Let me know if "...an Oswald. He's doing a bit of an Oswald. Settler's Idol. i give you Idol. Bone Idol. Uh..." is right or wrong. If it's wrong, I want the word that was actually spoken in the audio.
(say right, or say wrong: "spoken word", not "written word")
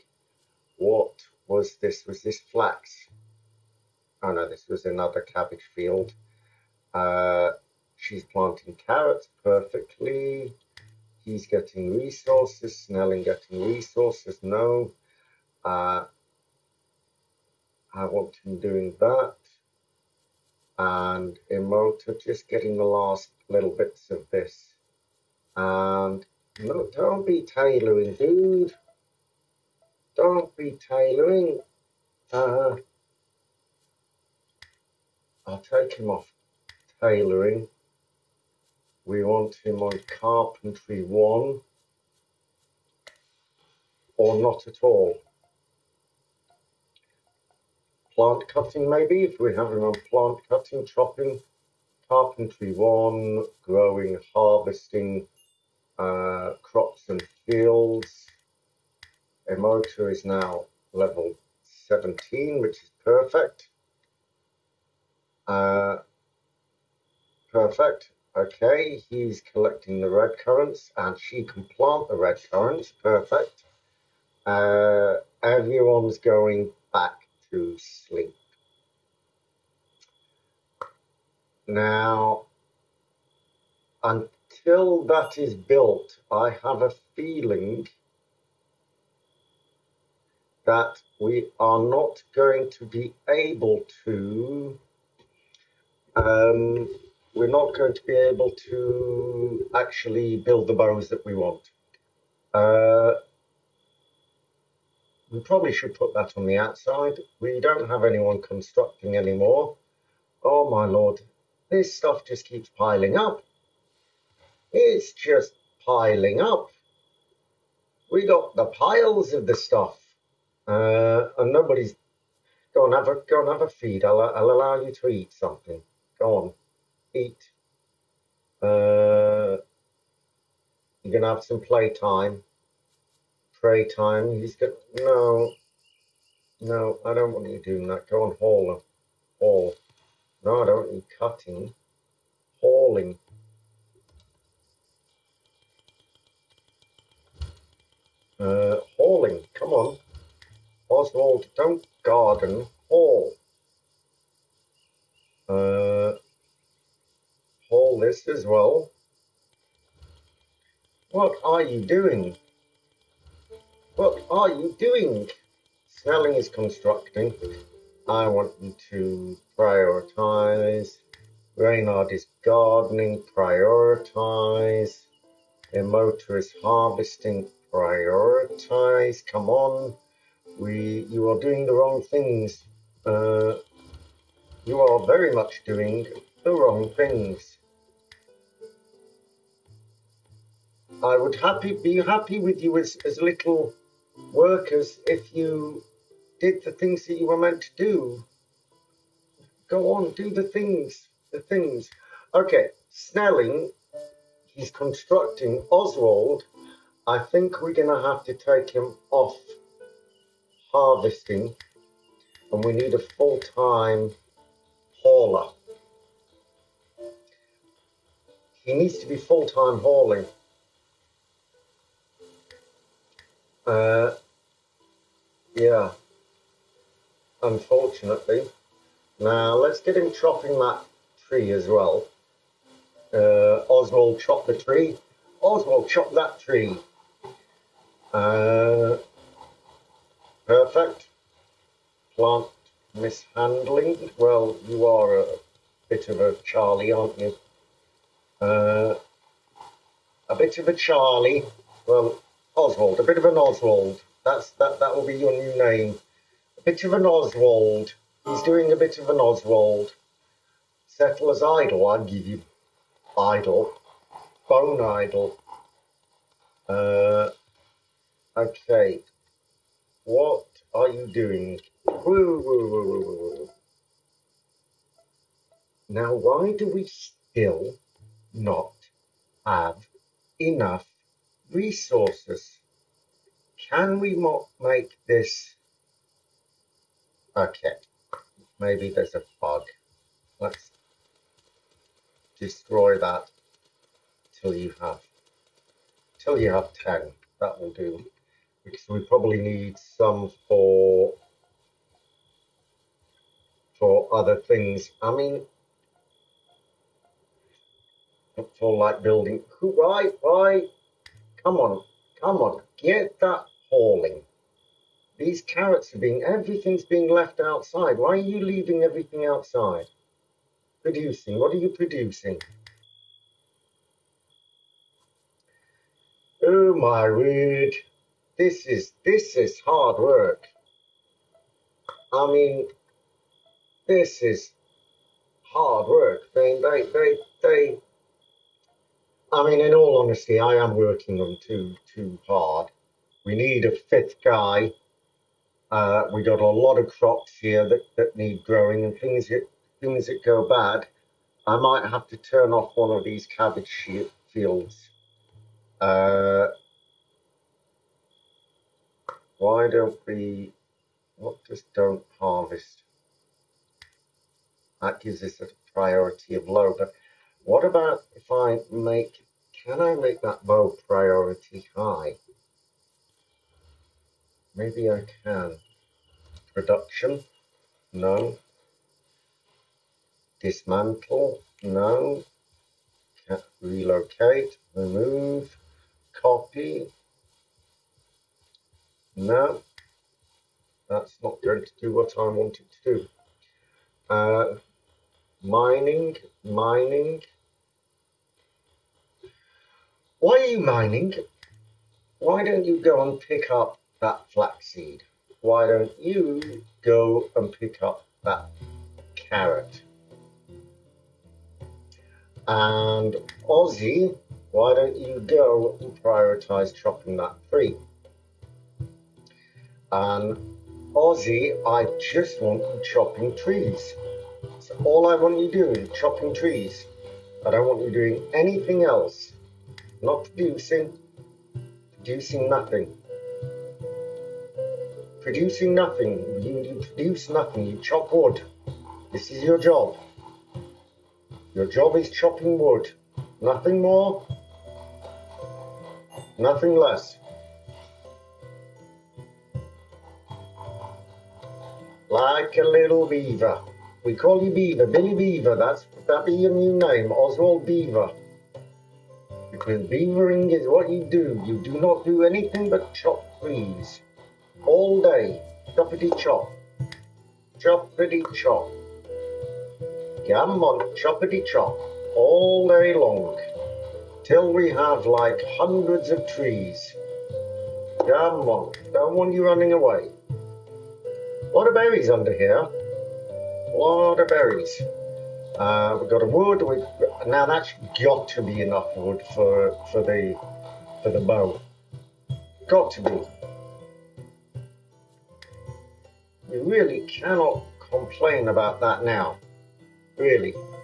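right.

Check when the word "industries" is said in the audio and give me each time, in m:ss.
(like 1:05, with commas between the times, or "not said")
not said.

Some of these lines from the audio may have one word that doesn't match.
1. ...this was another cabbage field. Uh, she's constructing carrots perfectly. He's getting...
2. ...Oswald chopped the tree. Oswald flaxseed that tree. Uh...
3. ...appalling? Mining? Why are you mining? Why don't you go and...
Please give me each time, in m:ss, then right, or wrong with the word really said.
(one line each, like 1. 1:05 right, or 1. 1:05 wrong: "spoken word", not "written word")
1. 0:04 wrong: "planting", not "constructing"
2. 3:53 wrong: "chopped", not "flaxseed"
3. 6:35 wrong: "mining", not "appalling".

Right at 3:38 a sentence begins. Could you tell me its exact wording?
He needs to be full-time hauling.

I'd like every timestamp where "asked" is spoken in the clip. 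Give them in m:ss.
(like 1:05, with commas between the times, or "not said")
not said.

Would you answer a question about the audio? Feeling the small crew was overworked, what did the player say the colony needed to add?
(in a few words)
A fifth guy.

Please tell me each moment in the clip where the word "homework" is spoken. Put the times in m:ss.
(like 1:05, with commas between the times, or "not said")
not said.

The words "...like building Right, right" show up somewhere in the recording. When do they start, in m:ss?
5:08.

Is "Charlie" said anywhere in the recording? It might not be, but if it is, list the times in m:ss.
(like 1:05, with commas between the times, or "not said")
4:06, 4:10.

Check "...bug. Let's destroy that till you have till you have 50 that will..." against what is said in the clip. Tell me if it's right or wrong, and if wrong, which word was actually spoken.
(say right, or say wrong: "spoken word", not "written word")
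wrong: "10", not "50".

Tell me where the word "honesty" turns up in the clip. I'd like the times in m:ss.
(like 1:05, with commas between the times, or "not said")
5:40.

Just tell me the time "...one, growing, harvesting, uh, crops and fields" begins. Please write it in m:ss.
0:52.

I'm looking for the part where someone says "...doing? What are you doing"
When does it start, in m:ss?
2:41.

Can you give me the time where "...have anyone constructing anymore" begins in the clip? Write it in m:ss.
1:47.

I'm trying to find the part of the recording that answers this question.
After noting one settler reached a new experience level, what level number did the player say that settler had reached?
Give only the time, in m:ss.
1:00.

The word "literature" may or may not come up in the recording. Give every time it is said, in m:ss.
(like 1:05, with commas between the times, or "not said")
not said.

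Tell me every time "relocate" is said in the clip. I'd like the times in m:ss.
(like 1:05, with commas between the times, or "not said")
6:23.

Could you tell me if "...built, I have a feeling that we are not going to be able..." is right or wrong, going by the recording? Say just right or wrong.
right.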